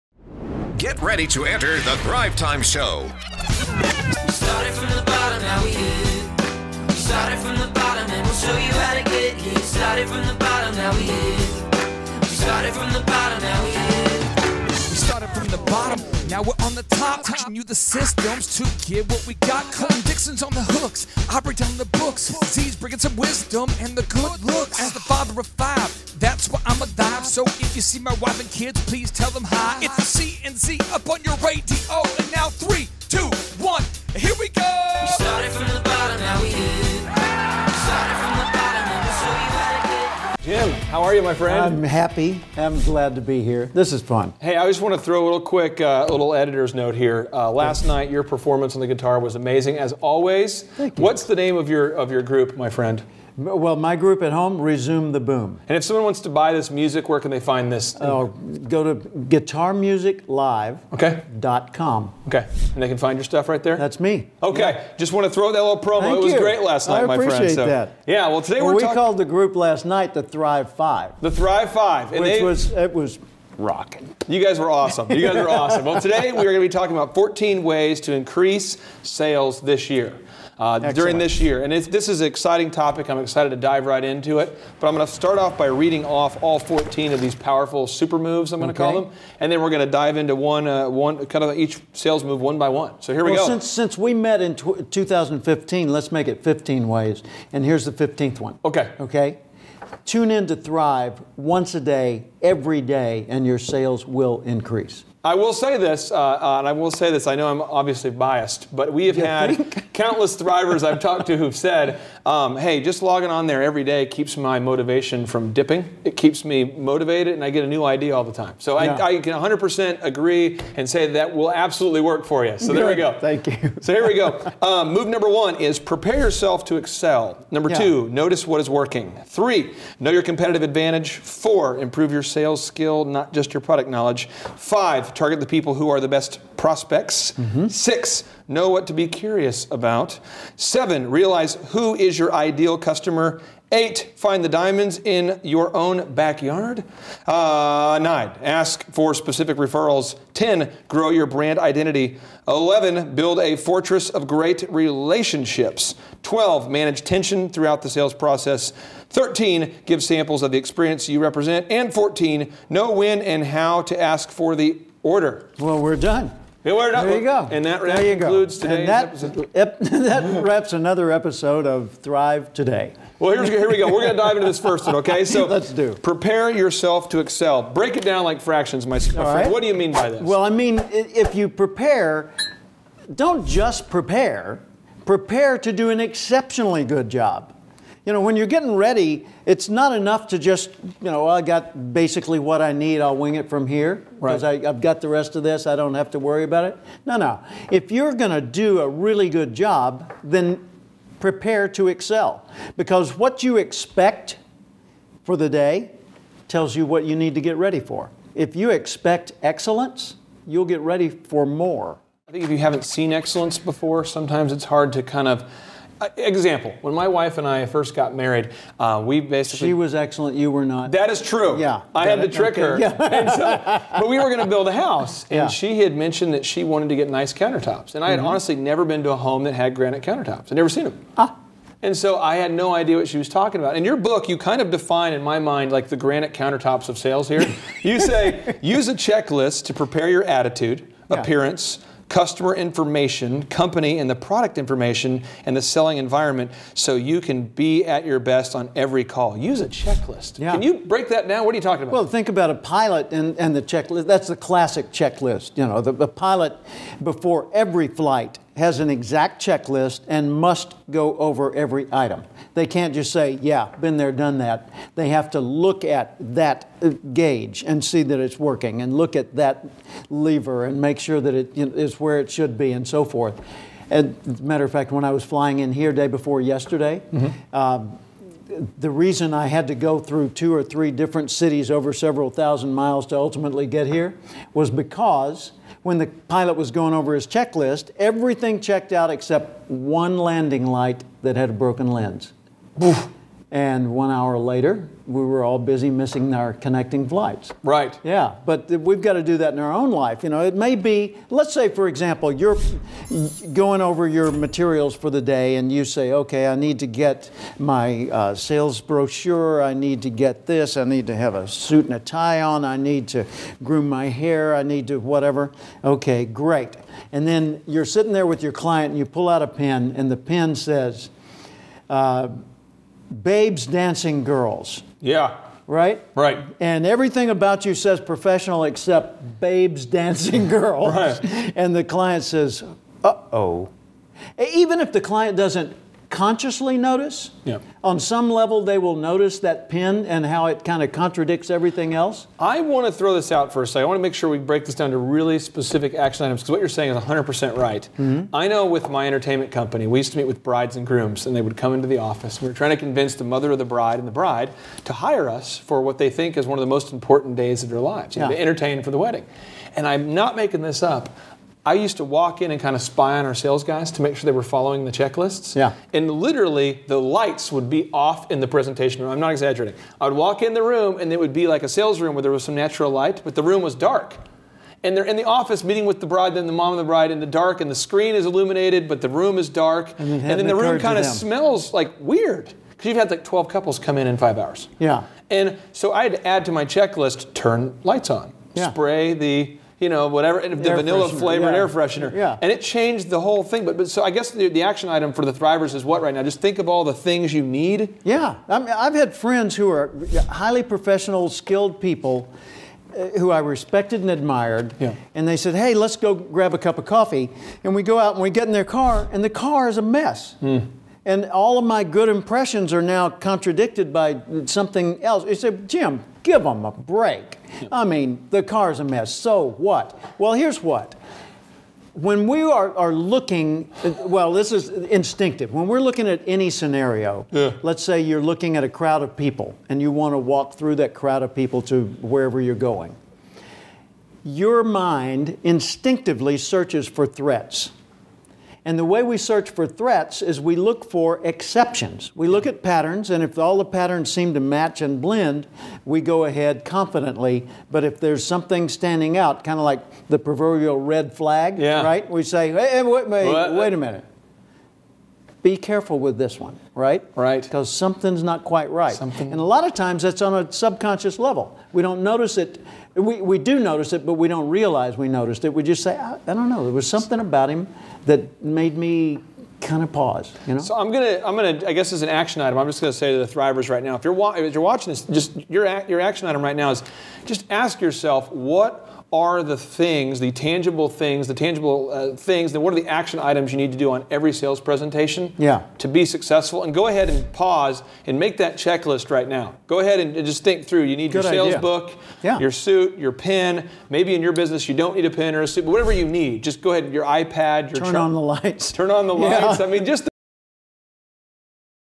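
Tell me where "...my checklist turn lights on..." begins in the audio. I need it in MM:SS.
06:26.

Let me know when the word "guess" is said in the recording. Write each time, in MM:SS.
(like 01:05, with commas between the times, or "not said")
06:34, 07:51.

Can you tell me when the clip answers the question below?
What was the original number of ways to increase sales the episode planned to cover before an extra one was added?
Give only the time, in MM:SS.
01:17.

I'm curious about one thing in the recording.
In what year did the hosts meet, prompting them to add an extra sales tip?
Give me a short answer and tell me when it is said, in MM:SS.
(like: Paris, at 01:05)
2015, at 01:34.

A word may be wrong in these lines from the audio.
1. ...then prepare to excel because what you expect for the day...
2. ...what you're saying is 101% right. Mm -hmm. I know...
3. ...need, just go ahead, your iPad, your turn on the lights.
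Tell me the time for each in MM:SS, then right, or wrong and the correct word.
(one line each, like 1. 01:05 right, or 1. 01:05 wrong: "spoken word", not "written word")
1. 03:20 right
2. 05:46 wrong: "100", not "101"
3. 08:16 right.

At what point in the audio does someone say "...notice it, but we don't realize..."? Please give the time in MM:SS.
07:43.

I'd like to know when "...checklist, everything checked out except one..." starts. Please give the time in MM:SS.
04:47.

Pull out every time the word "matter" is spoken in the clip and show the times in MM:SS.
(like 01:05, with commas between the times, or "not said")
04:34.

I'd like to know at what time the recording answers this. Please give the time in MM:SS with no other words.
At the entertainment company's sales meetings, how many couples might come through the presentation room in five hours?
06:23.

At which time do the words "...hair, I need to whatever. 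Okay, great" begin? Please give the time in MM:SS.
05:14.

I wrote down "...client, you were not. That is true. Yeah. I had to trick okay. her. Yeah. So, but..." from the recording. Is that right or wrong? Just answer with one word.
wrong.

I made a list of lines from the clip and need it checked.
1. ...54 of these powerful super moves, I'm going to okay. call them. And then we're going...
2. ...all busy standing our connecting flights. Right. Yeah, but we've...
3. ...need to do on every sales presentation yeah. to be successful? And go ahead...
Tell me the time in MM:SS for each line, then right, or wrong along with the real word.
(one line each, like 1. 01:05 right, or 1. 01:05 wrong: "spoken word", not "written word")
1. 01:26 wrong: "14", not "54"
2. 04:55 wrong: "missing", not "standing"
3. 08:03 right.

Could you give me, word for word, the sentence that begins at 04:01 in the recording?
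appearance, customer information, company and the product information, and the selling environment so you can be at your best on every call.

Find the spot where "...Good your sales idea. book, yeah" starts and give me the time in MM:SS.
08:11.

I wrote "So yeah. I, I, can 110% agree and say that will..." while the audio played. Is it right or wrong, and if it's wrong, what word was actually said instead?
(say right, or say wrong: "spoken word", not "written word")
wrong: "100", not "110".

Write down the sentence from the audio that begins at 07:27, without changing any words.
But if there's something standing out, kind of like the proverbial red flag, yeah.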